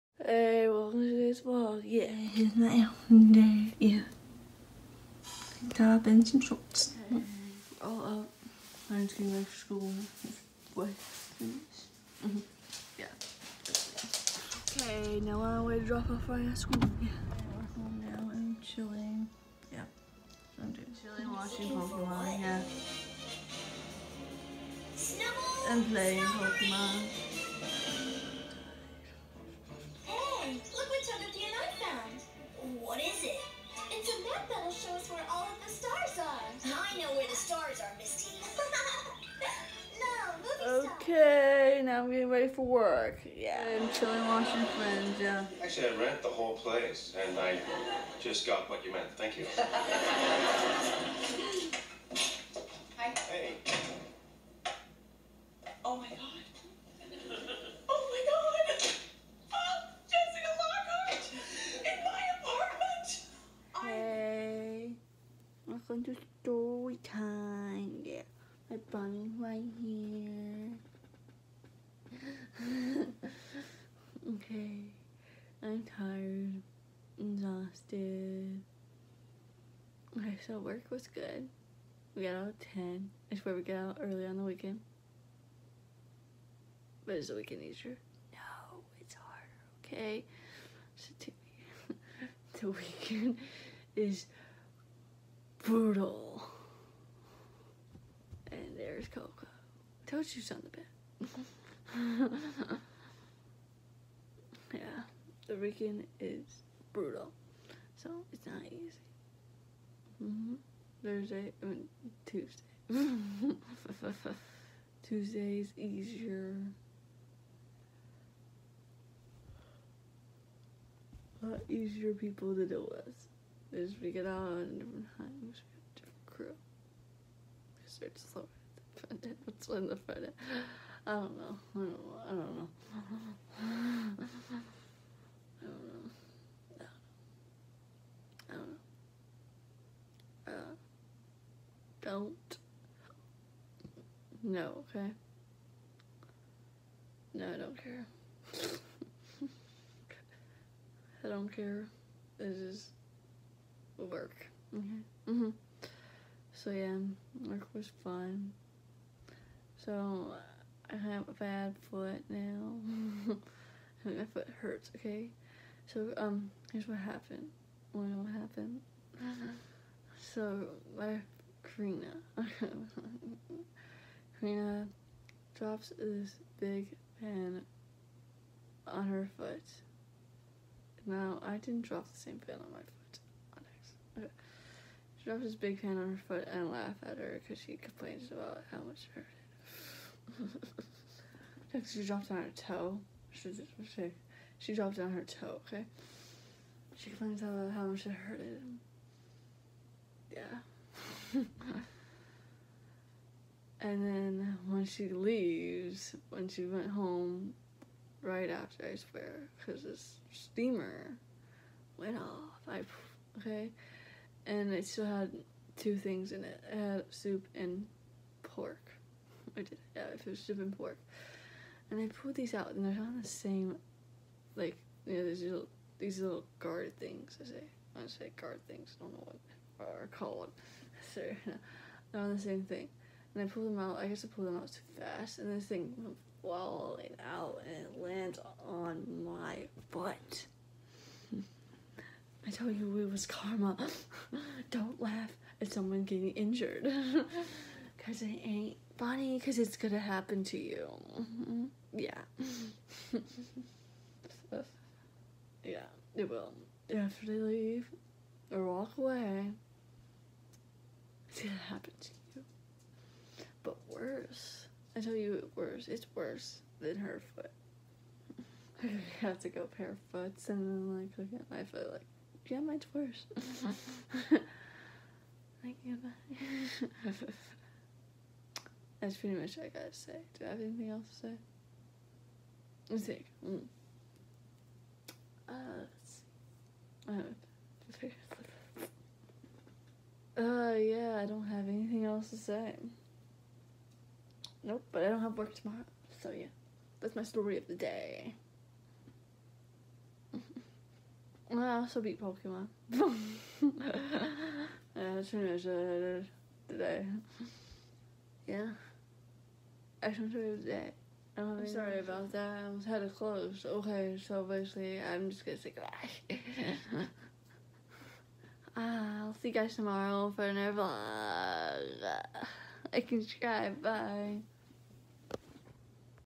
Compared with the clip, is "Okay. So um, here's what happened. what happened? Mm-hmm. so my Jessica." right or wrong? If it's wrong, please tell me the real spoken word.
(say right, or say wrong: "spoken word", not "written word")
wrong: "Karina", not "Jessica".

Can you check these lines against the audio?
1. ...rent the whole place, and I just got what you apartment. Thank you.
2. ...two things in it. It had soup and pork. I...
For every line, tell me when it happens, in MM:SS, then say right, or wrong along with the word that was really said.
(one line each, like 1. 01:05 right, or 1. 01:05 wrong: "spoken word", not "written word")
1. 00:45 wrong: "meant", not "apartment"
2. 03:35 right.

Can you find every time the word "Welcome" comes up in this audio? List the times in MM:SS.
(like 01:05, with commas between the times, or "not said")
01:05.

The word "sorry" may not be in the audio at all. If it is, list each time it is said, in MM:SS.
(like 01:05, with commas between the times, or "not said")
05:11.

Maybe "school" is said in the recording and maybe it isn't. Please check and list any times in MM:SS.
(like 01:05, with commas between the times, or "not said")
00:09, 00:16.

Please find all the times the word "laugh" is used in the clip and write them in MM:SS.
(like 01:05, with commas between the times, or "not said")
03:06, 04:04.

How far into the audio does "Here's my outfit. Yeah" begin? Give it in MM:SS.
00:02.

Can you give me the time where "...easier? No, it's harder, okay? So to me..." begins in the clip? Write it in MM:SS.
01:27.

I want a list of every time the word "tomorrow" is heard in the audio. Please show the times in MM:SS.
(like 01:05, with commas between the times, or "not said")
04:55, 05:19.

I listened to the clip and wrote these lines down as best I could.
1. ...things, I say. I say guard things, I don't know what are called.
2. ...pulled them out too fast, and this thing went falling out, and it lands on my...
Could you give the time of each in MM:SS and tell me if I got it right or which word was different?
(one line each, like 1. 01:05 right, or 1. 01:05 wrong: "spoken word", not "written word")
1. 03:46 right
2. 03:54 right.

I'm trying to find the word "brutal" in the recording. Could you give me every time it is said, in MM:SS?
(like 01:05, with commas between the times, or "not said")
01:35, 01:46.